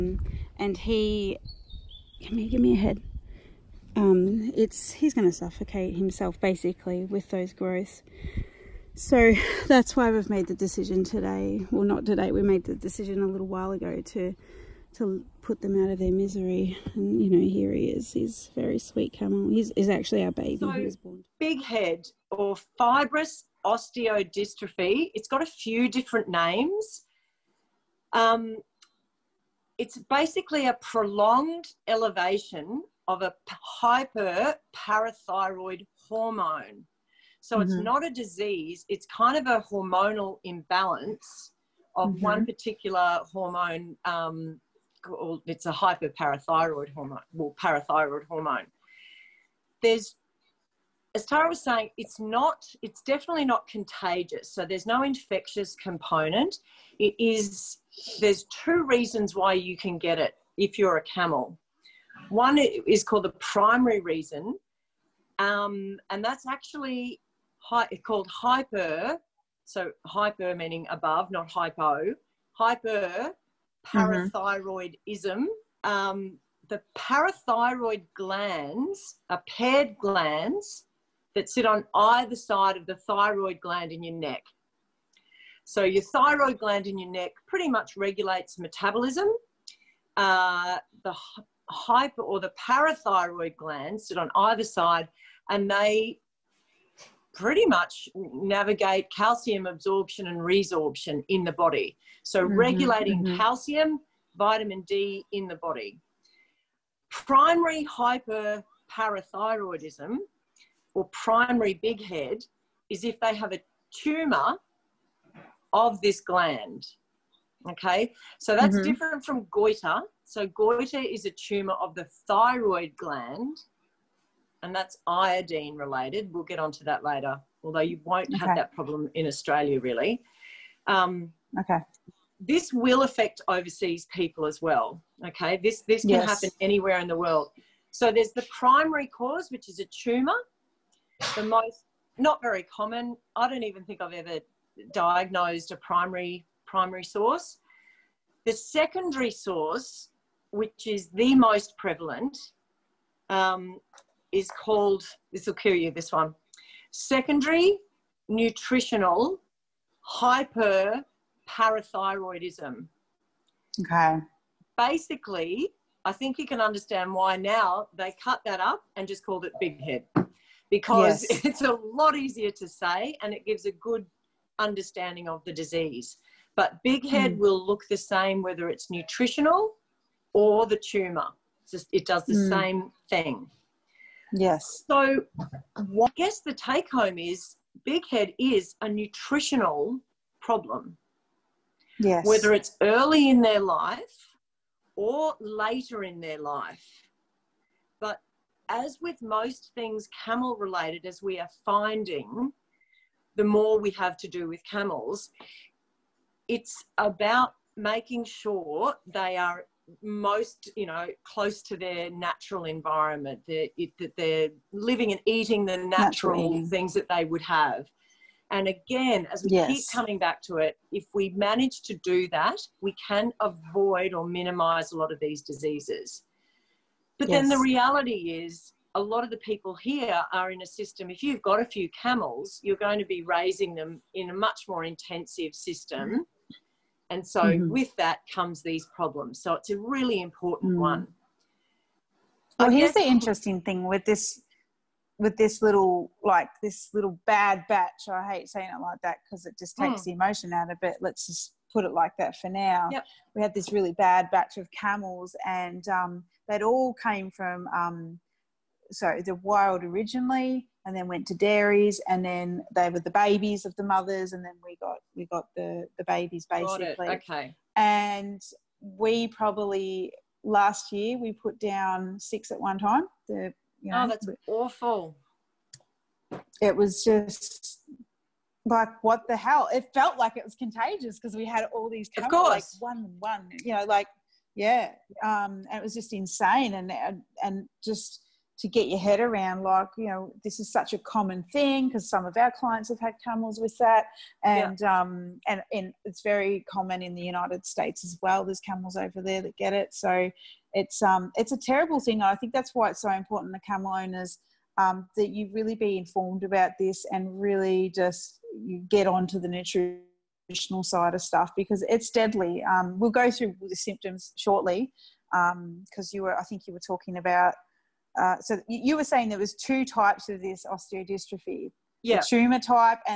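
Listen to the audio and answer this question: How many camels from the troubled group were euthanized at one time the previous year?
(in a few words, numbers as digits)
6.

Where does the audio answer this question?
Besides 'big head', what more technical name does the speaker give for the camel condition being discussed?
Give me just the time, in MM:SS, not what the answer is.
00:22.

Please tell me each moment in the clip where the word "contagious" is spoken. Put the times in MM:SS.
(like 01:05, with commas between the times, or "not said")
00:53, 04:40.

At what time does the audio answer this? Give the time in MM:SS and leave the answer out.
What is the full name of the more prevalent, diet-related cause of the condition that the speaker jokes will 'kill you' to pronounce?
02:36.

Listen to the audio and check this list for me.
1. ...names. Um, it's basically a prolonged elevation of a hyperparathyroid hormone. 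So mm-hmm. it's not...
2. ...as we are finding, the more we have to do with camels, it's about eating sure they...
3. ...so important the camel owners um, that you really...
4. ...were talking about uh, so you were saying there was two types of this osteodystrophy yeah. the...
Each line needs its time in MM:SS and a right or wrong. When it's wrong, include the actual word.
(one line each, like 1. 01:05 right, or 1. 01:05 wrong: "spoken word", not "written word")
1. 00:26 right
2. 03:21 wrong: "making", not "eating"
3. 05:03 right
4. 05:16 right.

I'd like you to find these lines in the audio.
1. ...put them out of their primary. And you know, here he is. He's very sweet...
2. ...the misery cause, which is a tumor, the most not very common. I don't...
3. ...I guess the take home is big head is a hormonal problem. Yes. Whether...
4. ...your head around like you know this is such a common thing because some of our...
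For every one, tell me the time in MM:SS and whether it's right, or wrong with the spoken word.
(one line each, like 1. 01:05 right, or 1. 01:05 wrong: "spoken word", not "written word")
1. 00:15 wrong: "misery", not "primary"
2. 02:18 wrong: "primary", not "misery"
3. 03:06 wrong: "nutritional", not "hormonal"
4. 04:48 right.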